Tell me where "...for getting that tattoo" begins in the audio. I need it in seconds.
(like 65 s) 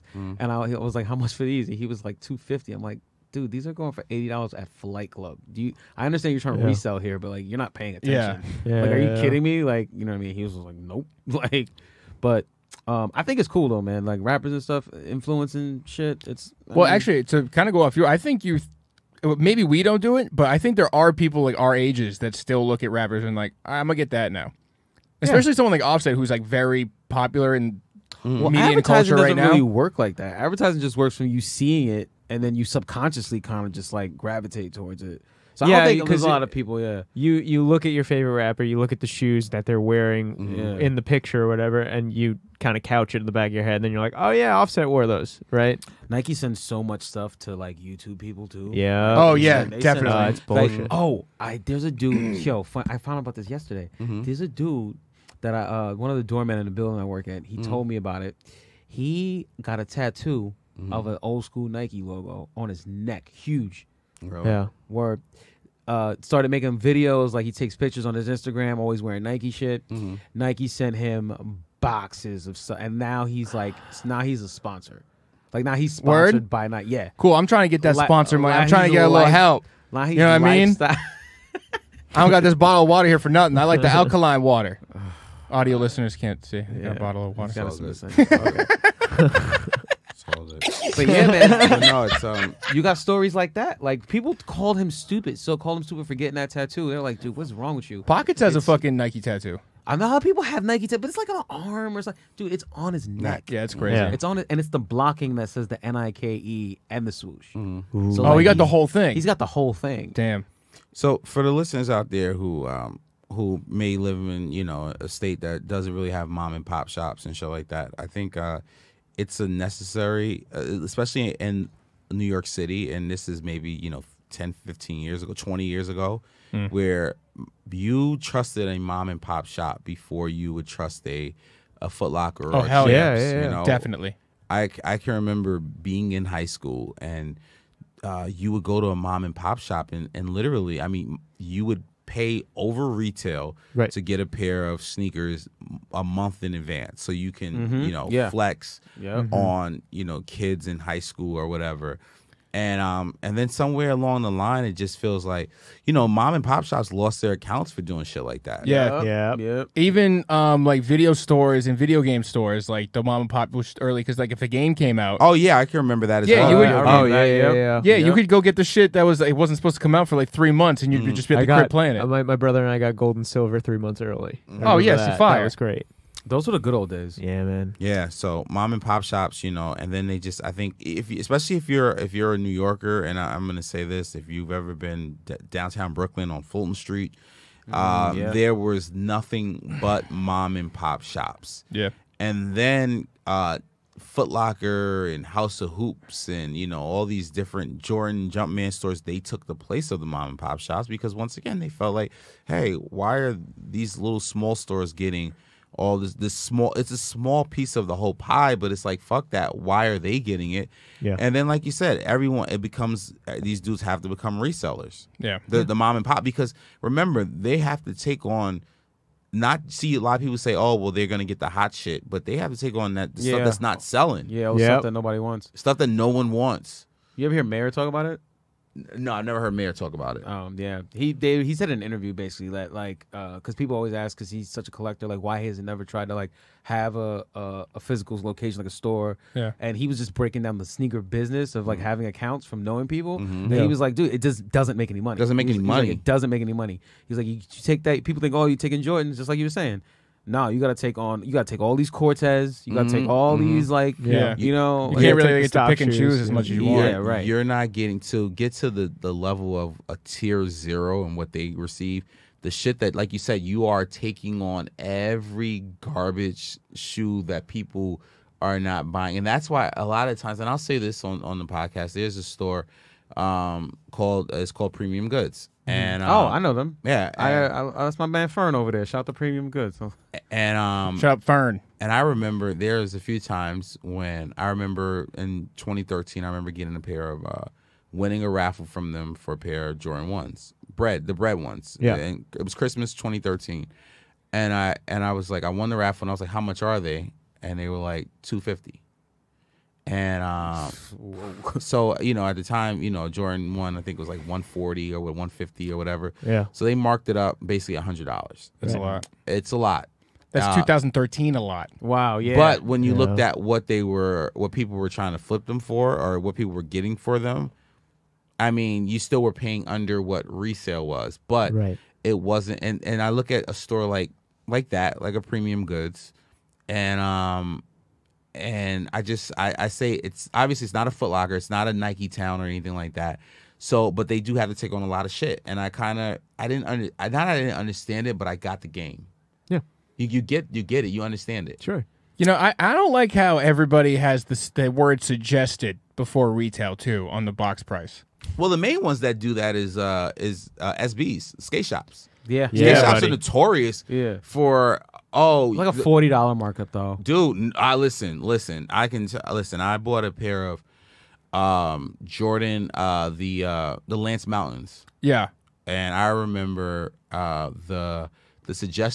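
96 s.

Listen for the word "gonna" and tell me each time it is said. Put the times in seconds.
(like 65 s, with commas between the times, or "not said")
23 s, 221 s.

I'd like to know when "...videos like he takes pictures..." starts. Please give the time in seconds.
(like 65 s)
66 s.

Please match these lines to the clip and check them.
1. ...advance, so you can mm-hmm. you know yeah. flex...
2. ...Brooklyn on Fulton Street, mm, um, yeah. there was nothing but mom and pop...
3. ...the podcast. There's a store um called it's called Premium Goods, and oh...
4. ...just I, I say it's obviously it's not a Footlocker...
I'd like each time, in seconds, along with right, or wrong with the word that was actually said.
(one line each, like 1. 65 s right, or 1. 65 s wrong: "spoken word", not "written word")
1. 146 s right
2. 185 s right
3. 271 s right
4. 329 s right.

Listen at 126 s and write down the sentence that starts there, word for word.
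where you trusted a mom and pop shop before you would trust a a Foot Locker oh, or hell yeah, yeah, yeah.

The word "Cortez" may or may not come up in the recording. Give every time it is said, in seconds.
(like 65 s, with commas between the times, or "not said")
251 s.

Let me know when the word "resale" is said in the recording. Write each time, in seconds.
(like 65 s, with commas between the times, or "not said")
320 s.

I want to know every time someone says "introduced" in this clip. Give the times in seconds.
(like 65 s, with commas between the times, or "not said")
not said.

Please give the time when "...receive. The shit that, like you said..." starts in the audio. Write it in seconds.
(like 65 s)
261 s.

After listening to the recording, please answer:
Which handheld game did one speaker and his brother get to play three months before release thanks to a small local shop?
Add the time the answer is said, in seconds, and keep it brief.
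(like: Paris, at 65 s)
Gold and Silver, at 172 s.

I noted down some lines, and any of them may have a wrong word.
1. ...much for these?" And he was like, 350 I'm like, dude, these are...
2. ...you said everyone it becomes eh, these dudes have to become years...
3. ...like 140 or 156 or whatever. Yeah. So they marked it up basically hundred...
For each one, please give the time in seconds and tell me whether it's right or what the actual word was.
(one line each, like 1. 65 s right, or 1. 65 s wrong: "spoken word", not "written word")
1. 1 s wrong: "250", not "350"
2. 211 s wrong: "resellers", not "years"
3. 304 s wrong: "150", not "156".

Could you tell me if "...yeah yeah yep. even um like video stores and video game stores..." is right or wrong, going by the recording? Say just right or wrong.
right.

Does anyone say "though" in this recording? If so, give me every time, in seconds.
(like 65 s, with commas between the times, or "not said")
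13 s, 356 s.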